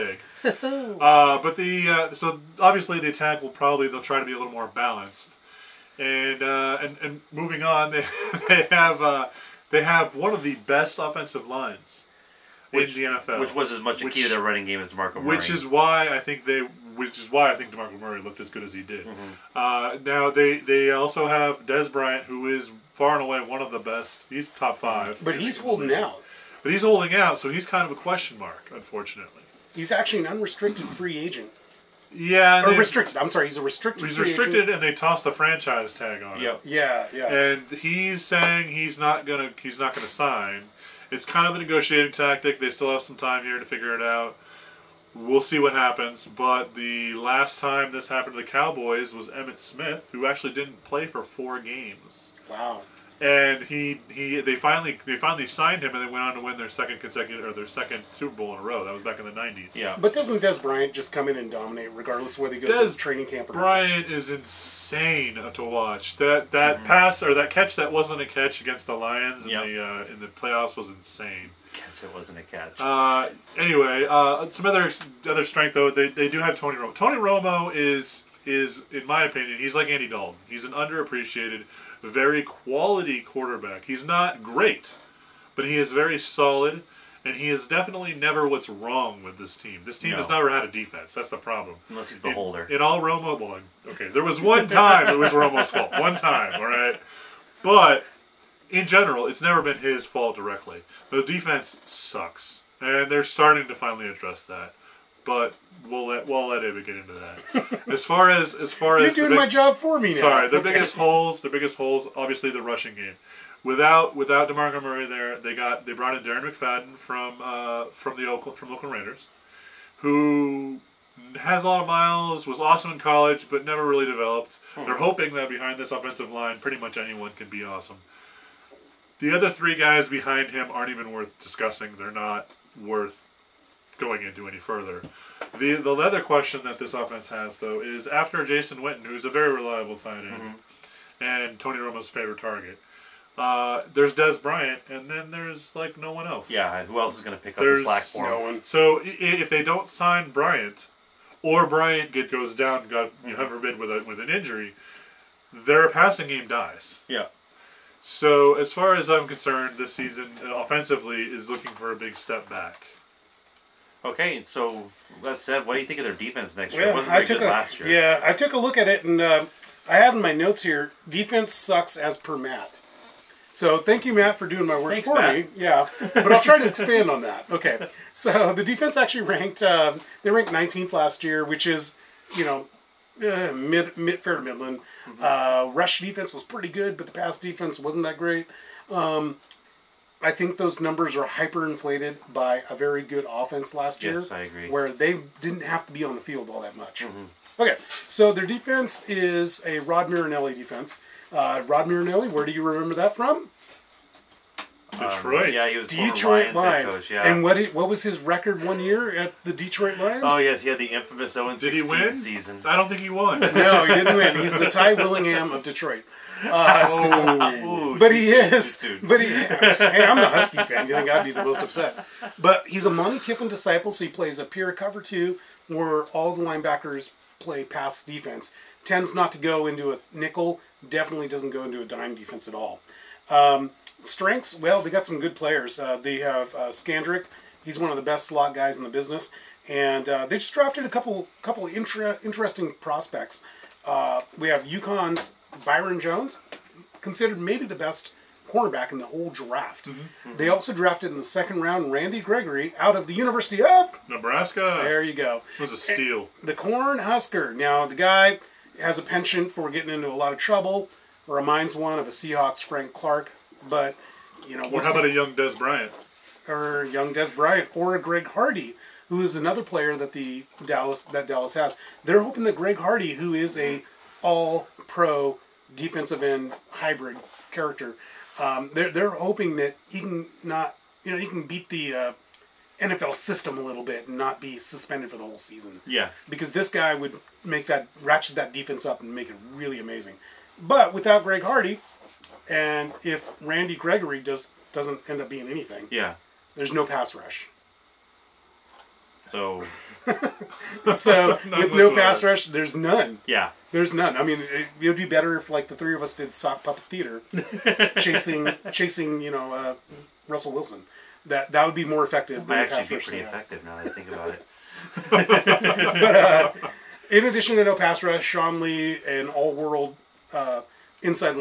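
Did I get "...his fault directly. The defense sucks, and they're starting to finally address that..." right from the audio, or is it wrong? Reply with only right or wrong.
right.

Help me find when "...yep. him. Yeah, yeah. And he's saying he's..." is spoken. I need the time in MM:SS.
00:36.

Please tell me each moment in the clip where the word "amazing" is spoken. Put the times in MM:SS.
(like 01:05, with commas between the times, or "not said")
04:49.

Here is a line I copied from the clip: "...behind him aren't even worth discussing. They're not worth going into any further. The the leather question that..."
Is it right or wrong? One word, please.
right.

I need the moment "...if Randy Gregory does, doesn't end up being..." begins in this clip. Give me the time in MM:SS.
04:53.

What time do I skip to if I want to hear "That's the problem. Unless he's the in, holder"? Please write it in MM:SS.
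01:31.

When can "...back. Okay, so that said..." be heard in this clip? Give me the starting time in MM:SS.
02:42.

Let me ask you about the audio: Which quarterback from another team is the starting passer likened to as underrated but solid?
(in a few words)
Andy Dalton.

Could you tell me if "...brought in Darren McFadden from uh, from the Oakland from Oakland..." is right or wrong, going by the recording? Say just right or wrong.
right.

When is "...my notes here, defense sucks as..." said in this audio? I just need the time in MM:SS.
02:50.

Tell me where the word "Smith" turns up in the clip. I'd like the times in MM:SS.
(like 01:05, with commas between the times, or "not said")
00:49.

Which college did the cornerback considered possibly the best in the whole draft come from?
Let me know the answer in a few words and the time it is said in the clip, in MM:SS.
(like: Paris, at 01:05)
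UConn, at 04:04.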